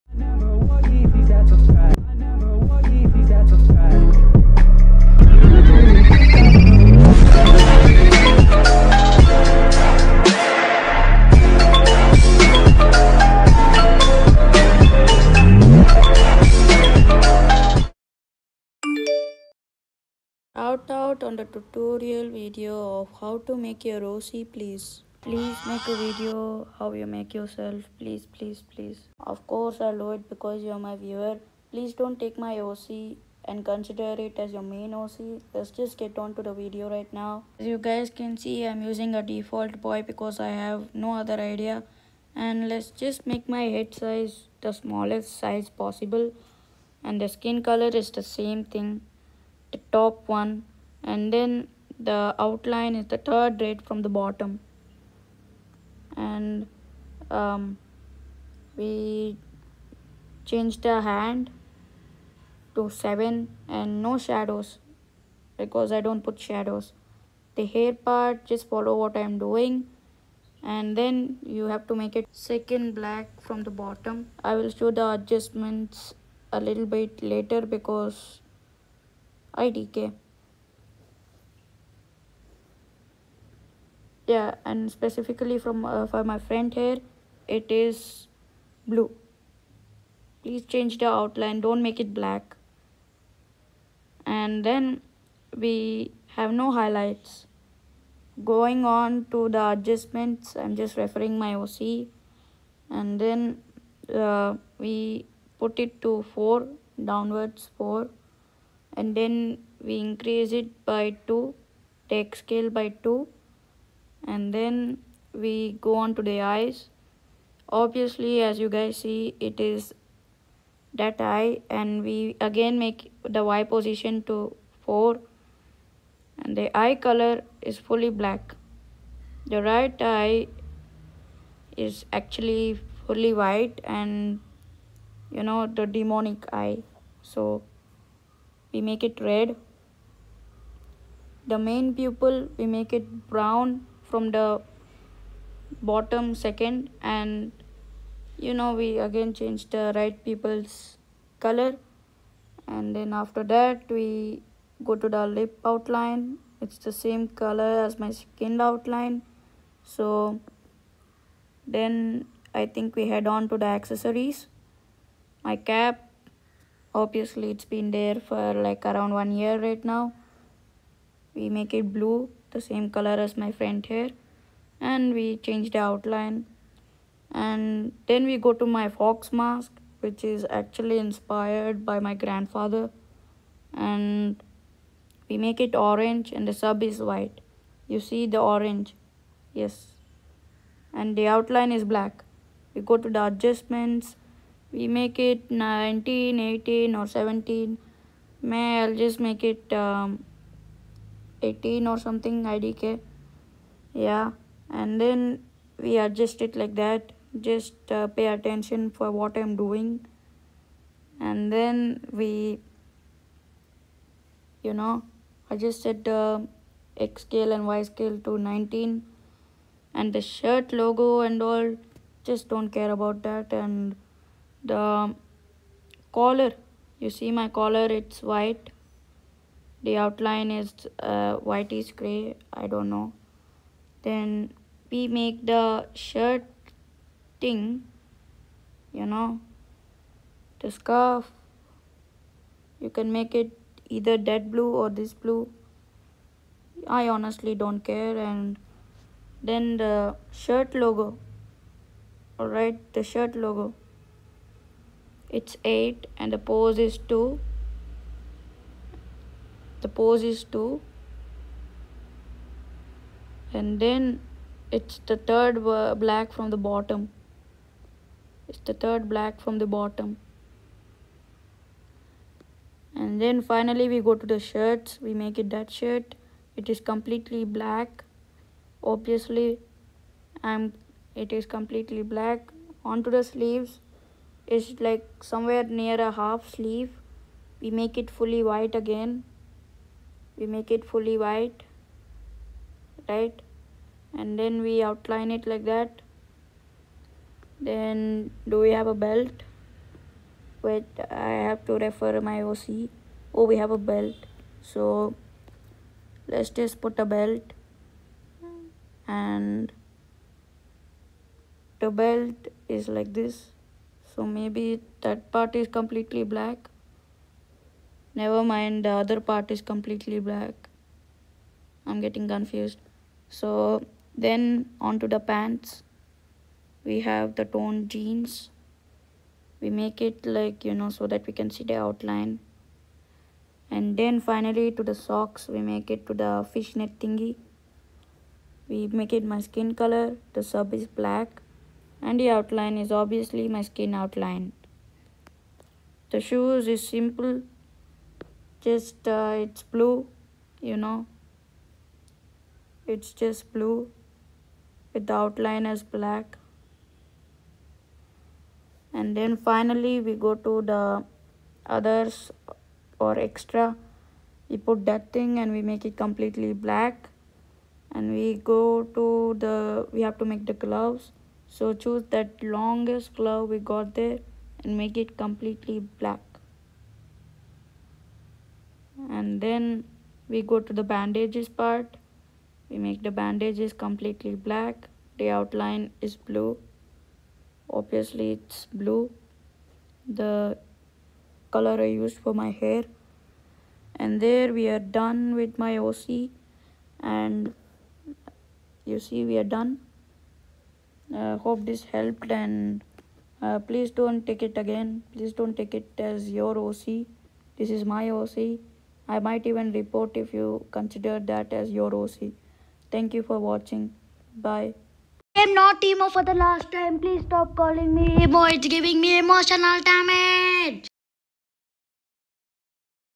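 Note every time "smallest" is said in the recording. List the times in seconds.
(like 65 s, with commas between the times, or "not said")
44 s.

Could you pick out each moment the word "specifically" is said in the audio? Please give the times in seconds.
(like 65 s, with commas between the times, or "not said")
84 s.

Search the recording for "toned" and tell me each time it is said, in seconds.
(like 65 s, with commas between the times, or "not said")
327 s.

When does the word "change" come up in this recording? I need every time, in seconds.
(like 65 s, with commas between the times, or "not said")
60 s, 90 s, 149 s, 175 s.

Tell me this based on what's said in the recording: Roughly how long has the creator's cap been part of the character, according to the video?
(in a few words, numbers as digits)
around one year.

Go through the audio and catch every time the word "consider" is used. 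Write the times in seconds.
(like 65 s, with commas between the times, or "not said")
33 s, 410 s.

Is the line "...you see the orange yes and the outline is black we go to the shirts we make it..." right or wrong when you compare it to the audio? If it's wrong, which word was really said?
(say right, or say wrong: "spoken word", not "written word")
wrong: "adjustments", not "shirts".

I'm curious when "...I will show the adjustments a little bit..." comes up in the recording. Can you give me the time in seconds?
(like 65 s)
74 s.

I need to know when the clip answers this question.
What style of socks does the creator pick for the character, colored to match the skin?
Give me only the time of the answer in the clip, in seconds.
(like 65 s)
336 s.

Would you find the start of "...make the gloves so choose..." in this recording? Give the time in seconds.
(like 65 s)
370 s.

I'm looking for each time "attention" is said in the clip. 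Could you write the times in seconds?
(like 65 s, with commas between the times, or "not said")
208 s.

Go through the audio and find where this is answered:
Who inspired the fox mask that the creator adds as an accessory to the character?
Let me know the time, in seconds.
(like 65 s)
181 s.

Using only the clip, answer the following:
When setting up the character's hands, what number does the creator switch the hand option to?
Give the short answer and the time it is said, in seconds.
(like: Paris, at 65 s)
7, at 62 s.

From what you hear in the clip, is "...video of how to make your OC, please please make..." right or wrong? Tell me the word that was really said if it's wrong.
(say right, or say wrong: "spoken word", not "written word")
right.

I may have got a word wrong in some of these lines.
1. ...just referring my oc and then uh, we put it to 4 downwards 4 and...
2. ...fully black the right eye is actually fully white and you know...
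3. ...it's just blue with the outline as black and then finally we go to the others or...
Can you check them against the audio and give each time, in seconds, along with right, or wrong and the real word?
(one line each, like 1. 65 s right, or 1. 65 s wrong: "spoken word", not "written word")
1. 100 s right
2. 127 s right
3. 352 s right.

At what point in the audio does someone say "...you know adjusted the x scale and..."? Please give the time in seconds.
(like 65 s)
214 s.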